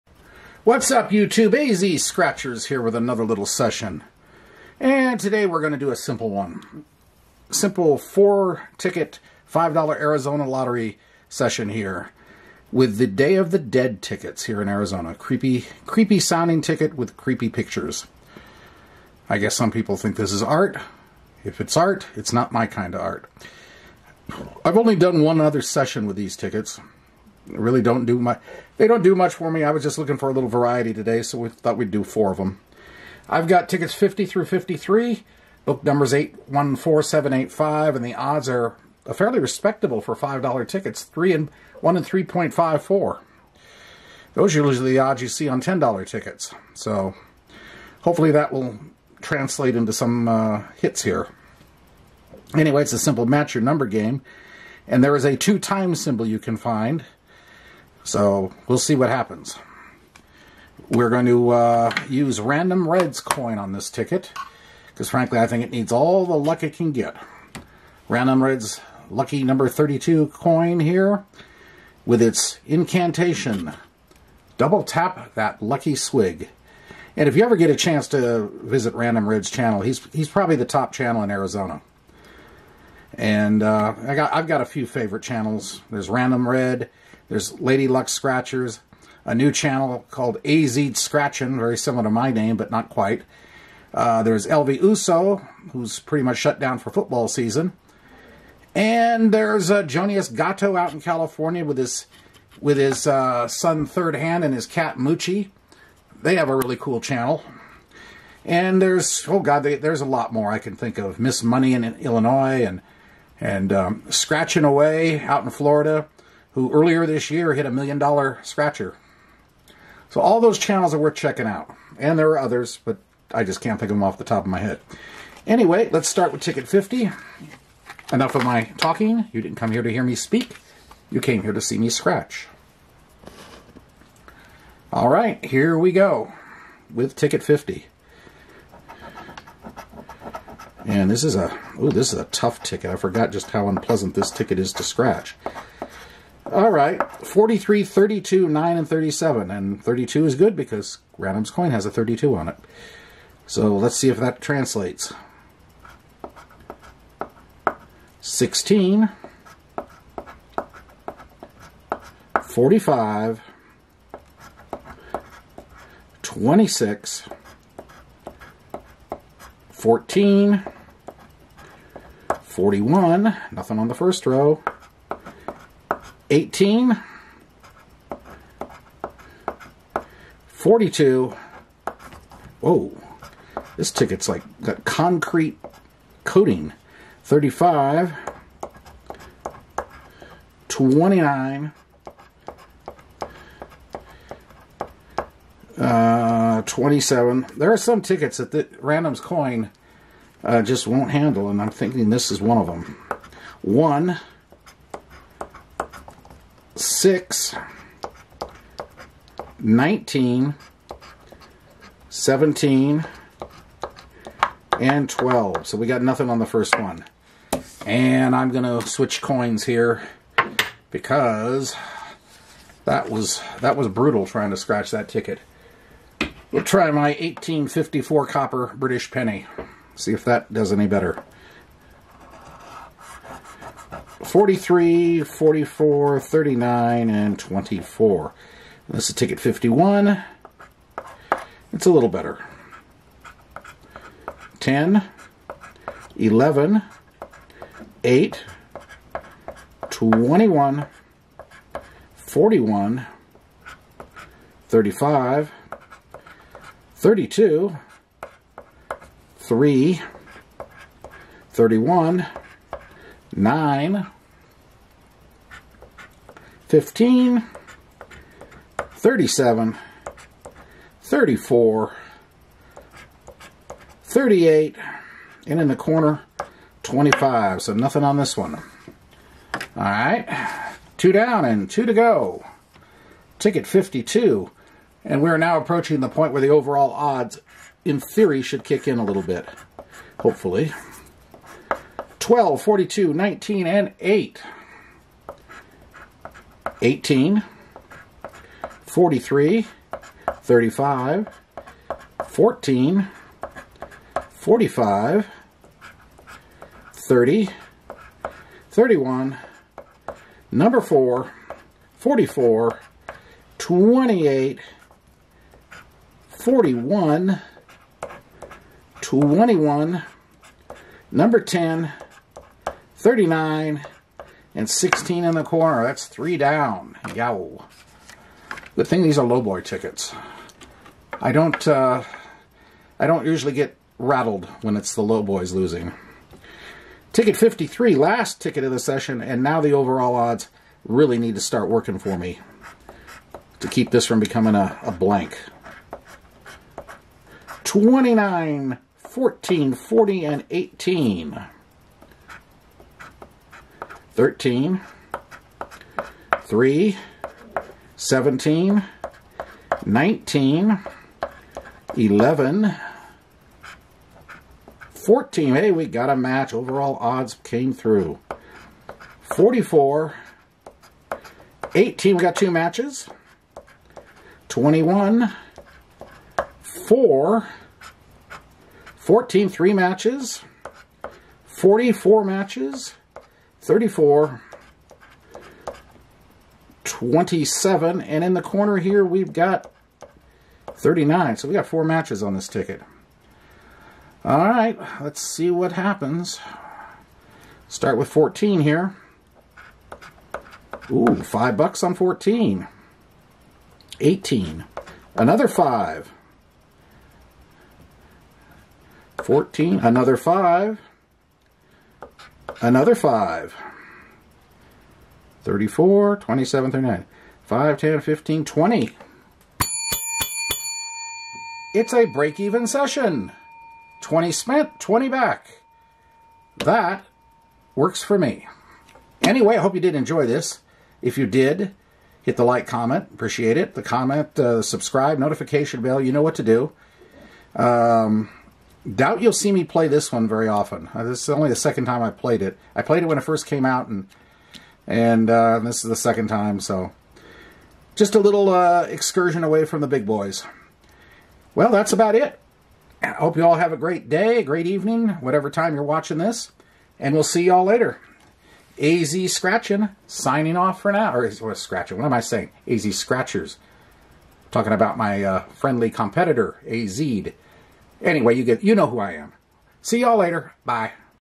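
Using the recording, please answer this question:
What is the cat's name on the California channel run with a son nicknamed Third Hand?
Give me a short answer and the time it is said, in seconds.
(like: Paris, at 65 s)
Moochie, at 104 s.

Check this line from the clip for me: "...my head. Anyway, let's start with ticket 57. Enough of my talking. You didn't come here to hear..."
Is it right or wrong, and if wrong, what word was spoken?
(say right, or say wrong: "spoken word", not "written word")
wrong: "50", not "57".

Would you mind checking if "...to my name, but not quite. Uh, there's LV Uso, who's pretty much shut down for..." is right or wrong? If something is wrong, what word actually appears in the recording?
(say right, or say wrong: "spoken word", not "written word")
right.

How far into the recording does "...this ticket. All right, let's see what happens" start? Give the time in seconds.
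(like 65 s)
392 s.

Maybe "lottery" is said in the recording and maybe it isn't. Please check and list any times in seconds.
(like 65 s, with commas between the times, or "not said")
10 s.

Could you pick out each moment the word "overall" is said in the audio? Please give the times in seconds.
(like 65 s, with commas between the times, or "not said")
286 s, 339 s.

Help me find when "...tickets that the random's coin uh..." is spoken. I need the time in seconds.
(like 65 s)
198 s.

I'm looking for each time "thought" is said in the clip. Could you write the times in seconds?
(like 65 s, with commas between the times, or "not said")
31 s.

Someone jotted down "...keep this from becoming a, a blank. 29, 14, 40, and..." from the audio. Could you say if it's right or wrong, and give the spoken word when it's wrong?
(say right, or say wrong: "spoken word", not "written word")
right.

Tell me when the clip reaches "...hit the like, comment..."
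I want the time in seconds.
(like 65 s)
432 s.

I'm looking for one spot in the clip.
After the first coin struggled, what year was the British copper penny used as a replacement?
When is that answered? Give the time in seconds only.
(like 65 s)
227 s.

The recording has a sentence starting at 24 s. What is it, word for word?
I've only done one other session with these tickets really don't do much.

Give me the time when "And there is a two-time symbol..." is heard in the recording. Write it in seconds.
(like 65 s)
54 s.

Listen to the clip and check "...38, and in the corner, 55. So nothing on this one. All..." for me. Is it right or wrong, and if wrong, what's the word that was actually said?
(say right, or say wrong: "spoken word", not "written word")
wrong: "25", not "55".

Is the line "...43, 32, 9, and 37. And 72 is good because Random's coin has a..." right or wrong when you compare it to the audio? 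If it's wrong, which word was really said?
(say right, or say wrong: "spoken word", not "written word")
wrong: "32", not "72".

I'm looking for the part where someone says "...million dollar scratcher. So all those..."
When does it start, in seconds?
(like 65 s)
117 s.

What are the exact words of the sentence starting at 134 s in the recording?
All right, here we go with ticket 50.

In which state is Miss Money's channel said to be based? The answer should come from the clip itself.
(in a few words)
Illinois.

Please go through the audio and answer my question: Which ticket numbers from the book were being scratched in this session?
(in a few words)
50 through 53.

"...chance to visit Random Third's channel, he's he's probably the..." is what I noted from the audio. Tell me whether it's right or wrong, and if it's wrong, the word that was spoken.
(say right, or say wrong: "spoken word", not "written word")
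wrong: "Red", not "Third".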